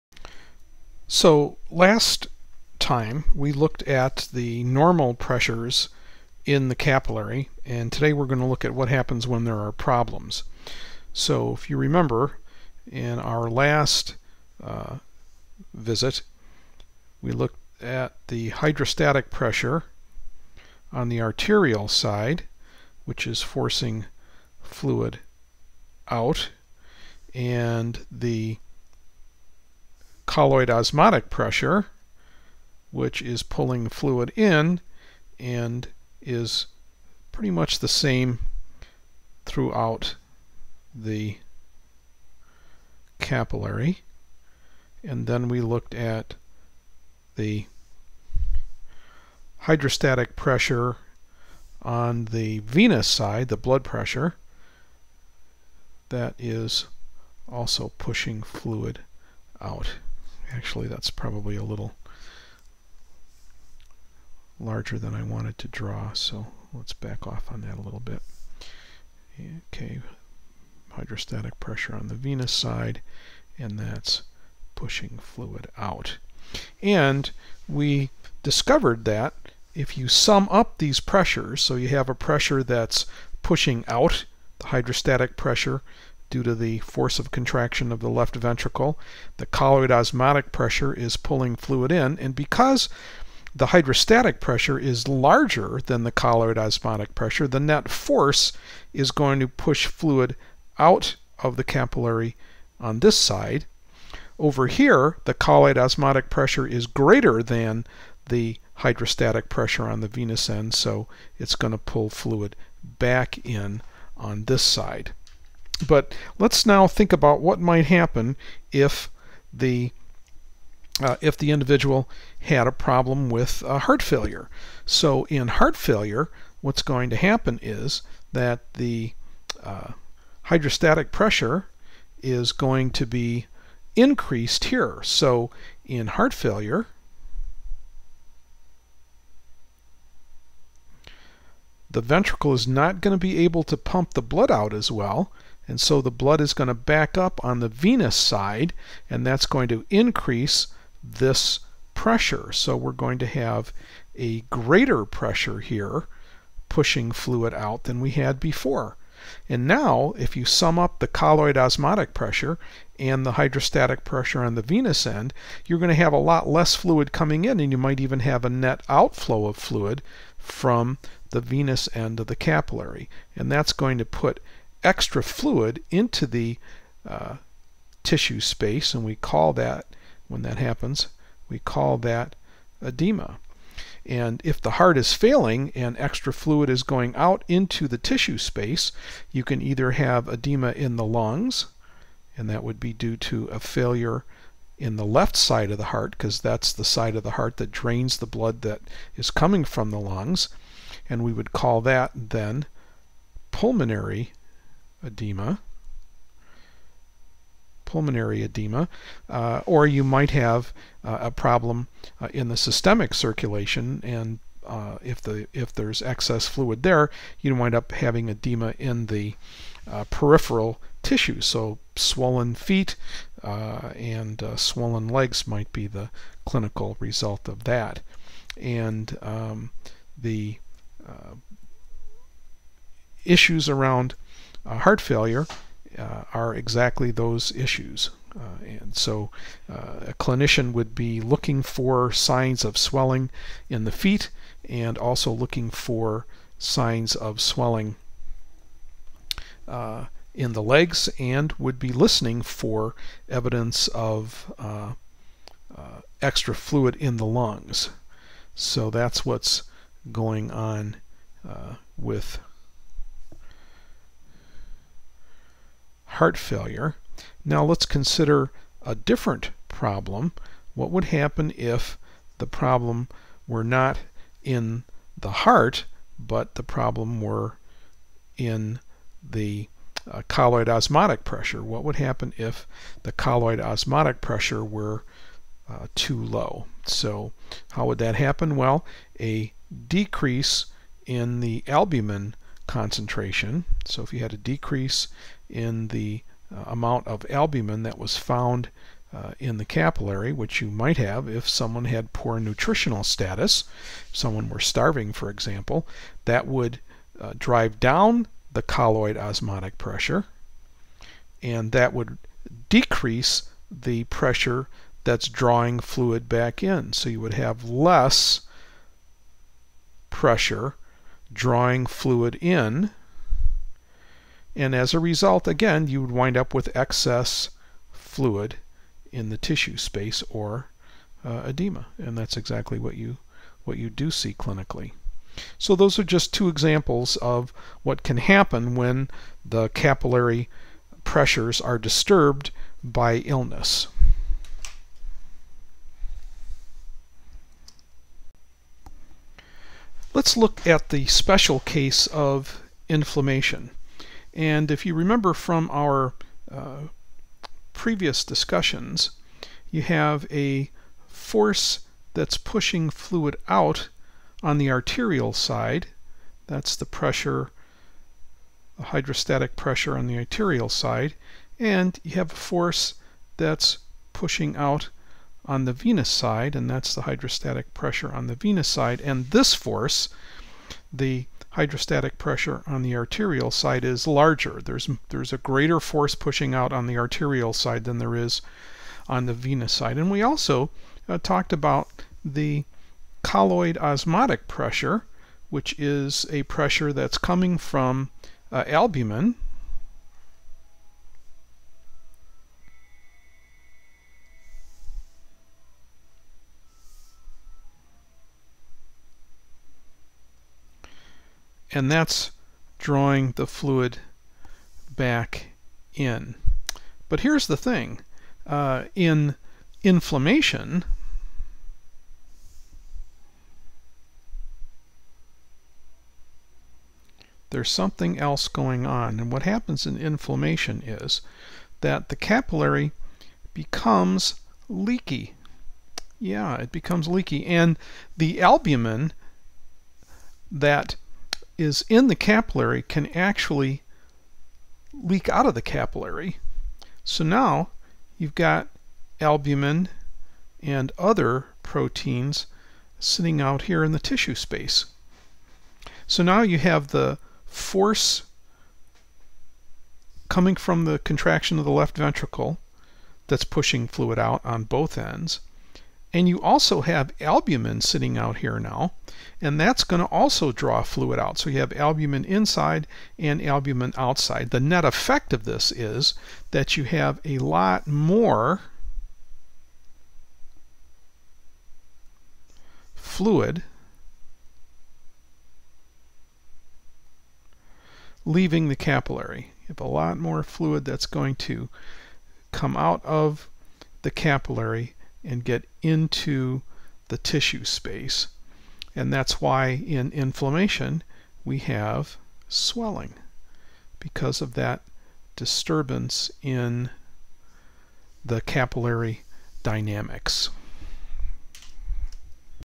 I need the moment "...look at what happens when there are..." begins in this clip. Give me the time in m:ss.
0:08.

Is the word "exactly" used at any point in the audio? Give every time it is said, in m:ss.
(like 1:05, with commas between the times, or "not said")
3:56, 5:32.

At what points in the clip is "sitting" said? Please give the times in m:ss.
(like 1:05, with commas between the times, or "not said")
7:32, 7:47.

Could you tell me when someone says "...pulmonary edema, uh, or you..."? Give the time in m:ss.
3:27.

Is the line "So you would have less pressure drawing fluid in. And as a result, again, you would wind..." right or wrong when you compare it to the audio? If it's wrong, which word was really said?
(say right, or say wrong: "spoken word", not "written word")
right.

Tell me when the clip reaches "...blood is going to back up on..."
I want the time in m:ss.
2:26.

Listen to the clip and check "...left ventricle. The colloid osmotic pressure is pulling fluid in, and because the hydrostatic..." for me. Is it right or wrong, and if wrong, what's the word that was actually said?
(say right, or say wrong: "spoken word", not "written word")
right.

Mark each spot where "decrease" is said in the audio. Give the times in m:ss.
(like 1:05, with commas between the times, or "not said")
4:49, 4:54, 5:12.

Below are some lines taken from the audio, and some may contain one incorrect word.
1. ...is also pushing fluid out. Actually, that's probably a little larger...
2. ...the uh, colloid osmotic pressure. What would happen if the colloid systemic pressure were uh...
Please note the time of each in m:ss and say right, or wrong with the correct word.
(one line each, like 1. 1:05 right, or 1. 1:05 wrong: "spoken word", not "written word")
1. 0:56 right
2. 4:39 wrong: "osmotic", not "systemic".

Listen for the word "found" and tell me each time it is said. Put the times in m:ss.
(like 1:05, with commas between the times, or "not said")
4:58.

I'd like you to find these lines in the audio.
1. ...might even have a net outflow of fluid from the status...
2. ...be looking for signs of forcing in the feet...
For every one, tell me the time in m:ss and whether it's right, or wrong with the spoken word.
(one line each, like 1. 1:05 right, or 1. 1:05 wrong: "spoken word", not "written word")
1. 2:47 wrong: "venous", not "status"
2. 4:00 wrong: "swelling", not "forcing".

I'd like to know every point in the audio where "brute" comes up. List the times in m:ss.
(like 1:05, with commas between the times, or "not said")
not said.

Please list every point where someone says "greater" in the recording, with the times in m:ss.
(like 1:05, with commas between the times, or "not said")
1:46, 2:34, 6:25.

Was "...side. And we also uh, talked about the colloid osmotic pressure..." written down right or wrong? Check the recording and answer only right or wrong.
right.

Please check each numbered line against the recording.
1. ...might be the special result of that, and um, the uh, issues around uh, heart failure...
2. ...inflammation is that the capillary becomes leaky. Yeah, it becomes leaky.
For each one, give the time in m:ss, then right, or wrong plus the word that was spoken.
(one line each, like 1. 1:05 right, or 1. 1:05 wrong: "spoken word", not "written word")
1. 3:45 wrong: "clinical", not "special"
2. 7:09 right.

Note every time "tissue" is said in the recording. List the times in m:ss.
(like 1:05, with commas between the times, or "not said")
2:58, 3:07, 3:41, 5:29, 7:33, 8:17.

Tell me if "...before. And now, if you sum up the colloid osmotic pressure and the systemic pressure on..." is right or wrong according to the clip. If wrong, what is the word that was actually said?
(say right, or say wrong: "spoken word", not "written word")
wrong: "hydrostatic", not "systemic".